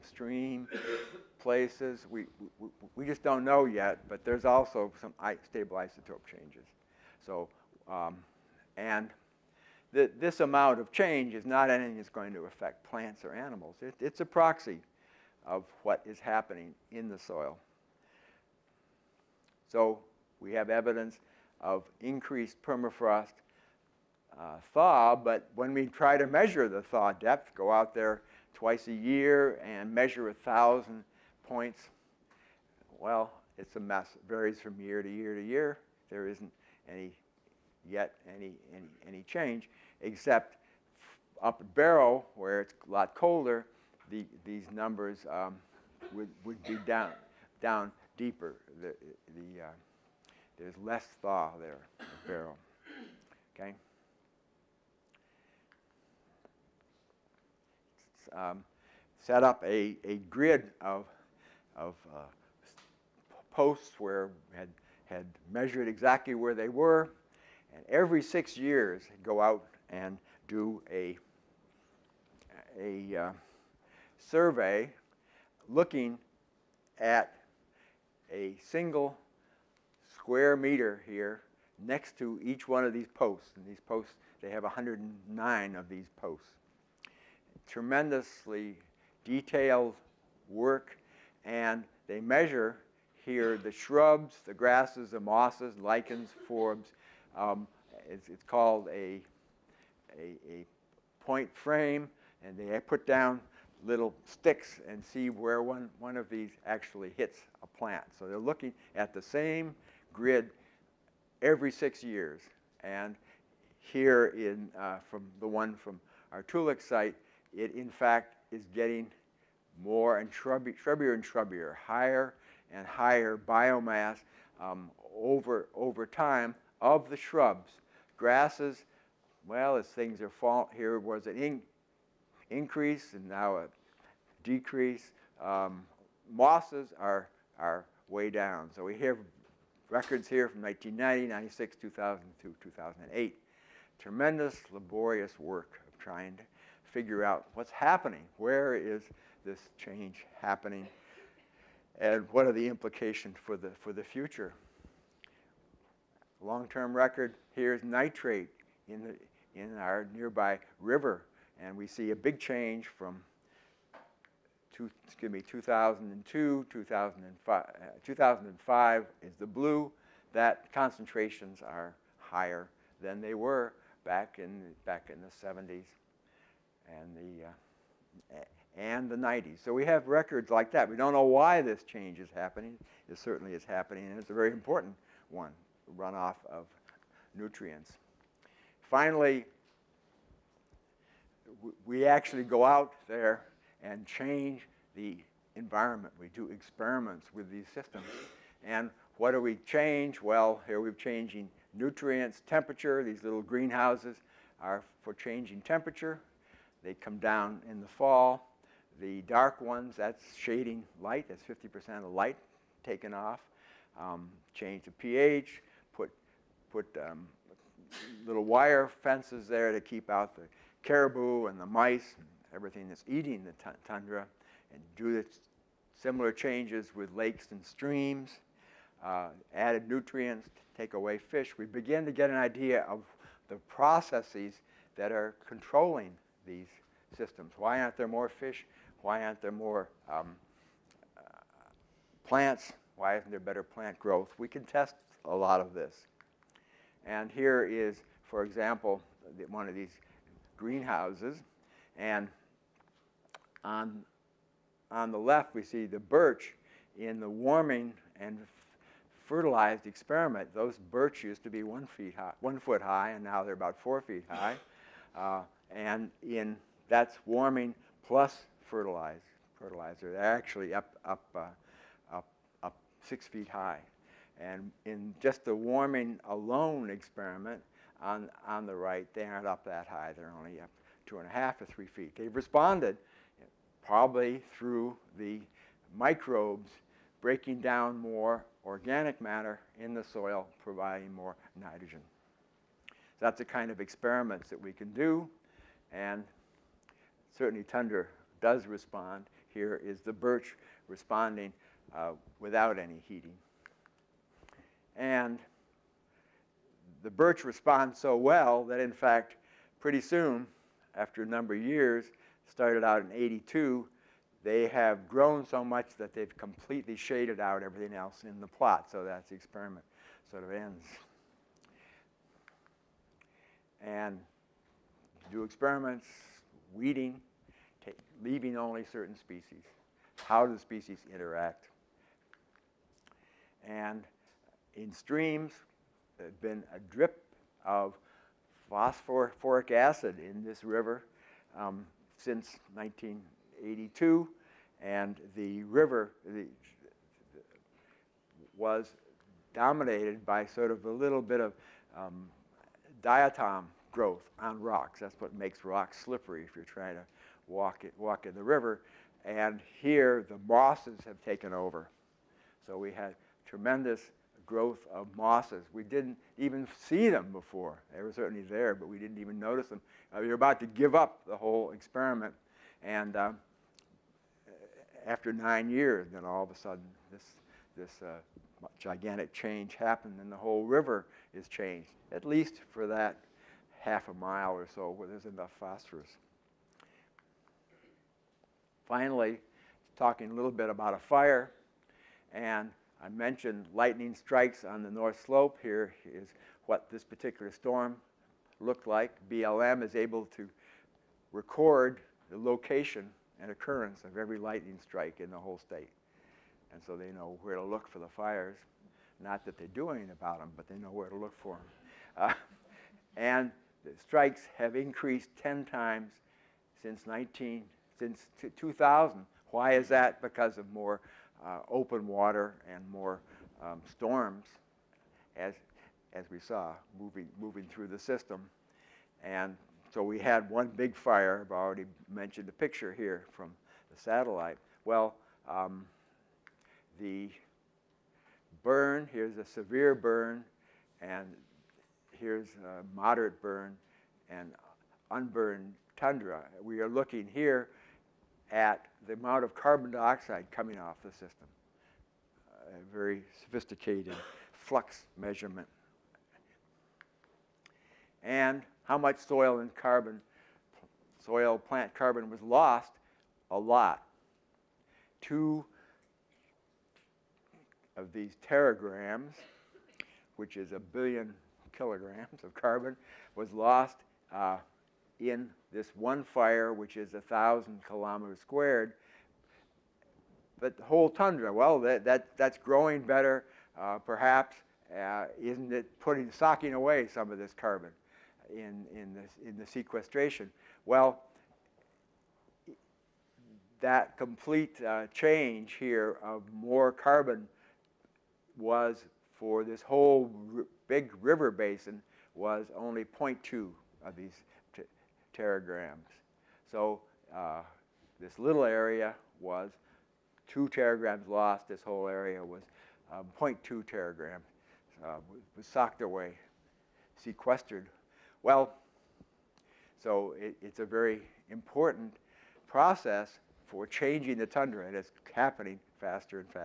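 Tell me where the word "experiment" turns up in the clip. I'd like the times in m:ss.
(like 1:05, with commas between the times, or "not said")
3:16, 4:19, 4:36, 4:53, 5:19, 5:25, 6:11.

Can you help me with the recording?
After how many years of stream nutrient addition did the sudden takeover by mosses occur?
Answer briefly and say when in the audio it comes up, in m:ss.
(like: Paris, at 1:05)
9 years, at 6:15.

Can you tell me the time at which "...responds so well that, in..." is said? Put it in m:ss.
5:07.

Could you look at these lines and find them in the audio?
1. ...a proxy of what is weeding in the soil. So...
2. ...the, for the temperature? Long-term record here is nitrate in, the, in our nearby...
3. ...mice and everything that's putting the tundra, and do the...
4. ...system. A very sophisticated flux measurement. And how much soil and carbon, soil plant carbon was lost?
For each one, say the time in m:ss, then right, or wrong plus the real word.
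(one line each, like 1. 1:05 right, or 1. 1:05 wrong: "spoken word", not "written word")
1. 0:14 wrong: "happening", not "weeding"
2. 2:33 wrong: "future", not "temperature"
3. 3:41 wrong: "eating", not "putting"
4. 7:31 right.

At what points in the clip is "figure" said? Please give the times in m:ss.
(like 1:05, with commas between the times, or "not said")
2:26.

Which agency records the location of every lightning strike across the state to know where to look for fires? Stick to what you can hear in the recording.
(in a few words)
BLM.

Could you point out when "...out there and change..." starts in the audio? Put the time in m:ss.
3:12.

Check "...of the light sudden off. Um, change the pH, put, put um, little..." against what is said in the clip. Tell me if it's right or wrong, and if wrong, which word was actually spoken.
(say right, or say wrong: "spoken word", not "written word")
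wrong: "taken", not "sudden".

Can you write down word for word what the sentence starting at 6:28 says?
Finally, talking a little bit about a fire, and I mentioned lightning strikes on the north slope.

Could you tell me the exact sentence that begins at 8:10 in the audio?
Well, that complete uh, change here of more carbon was for this whole big river basin was only 0.2 of these teragrams.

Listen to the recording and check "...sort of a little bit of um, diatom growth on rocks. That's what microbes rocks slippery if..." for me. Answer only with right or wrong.
wrong.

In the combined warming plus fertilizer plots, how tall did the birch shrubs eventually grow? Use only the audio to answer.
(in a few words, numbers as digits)
6 feet.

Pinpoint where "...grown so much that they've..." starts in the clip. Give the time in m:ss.
5:15.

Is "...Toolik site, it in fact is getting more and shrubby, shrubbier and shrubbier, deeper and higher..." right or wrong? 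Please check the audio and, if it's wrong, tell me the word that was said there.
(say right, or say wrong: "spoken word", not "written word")
wrong: "higher", not "deeper".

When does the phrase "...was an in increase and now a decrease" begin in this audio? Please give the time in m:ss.
2:10.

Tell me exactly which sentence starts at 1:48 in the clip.
So they're looking at the same grid every six years.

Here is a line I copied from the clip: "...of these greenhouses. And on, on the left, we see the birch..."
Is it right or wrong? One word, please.
right.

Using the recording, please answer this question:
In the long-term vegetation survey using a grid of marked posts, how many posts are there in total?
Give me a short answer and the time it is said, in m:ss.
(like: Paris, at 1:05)
109, at 1:24.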